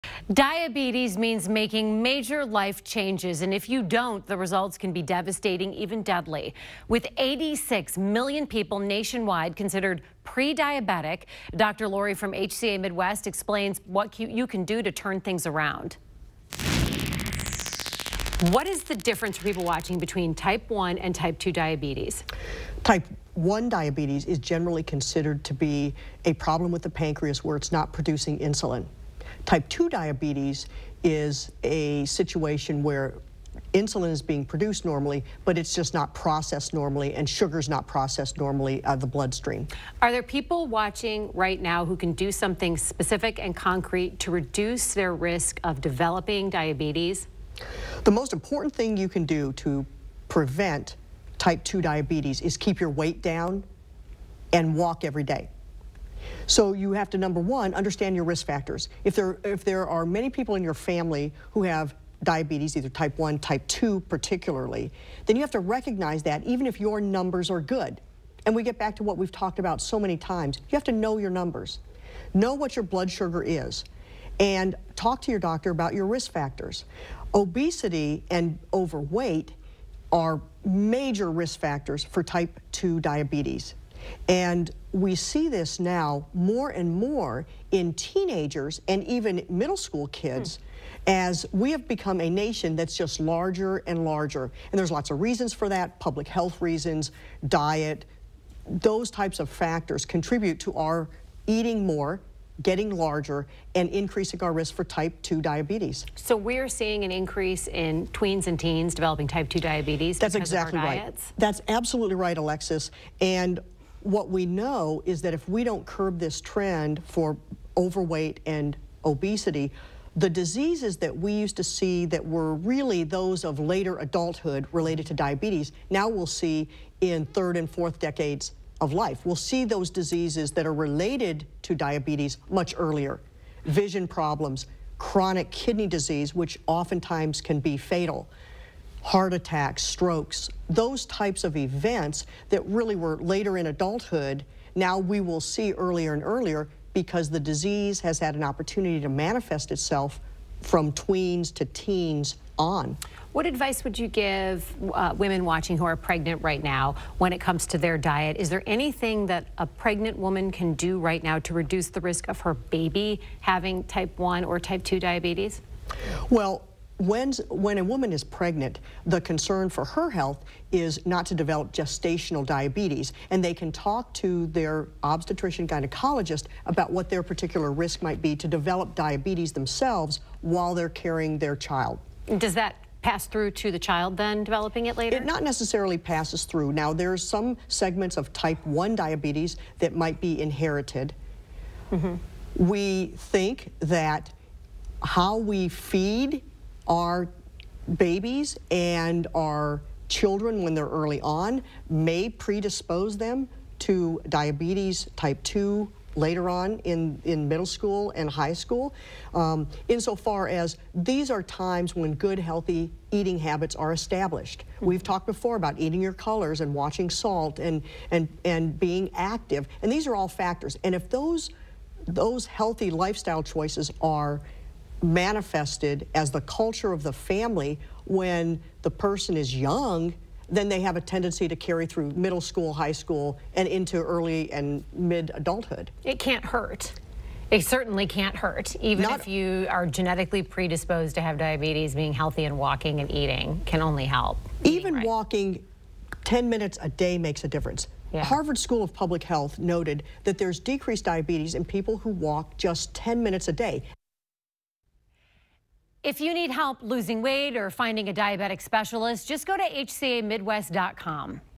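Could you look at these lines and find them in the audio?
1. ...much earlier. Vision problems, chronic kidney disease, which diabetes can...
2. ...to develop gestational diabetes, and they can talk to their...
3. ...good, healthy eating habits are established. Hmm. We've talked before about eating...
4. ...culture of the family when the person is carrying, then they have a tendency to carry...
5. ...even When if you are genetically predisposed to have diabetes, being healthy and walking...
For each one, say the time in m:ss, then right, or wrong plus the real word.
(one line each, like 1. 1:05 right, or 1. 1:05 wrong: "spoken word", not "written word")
1. 2:12 wrong: "oftentimes", not "diabetes"
2. 2:51 right
3. 3:32 right
4. 3:46 wrong: "young", not "carrying"
5. 3:58 wrong: "Not", not "When".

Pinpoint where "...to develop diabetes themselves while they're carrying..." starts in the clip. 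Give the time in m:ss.
2:58.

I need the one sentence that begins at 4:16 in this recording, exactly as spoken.
If you need help losing weight or finding a diabetic specialist, just go to hcamidwest.com.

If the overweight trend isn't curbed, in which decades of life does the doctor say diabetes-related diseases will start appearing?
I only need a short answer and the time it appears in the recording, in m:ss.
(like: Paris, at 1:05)
third and fourth decades, at 2:07.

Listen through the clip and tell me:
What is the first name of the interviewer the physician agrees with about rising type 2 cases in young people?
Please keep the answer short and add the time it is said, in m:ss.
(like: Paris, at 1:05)
Alexis, at 1:52.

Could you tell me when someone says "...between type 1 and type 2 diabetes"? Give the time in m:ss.
0:19.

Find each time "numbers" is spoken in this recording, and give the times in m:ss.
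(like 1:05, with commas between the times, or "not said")
0:57, 1:07, 1:11.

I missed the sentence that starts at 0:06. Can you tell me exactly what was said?
With 86 million people nationwide considered pre-diabetic, Dr.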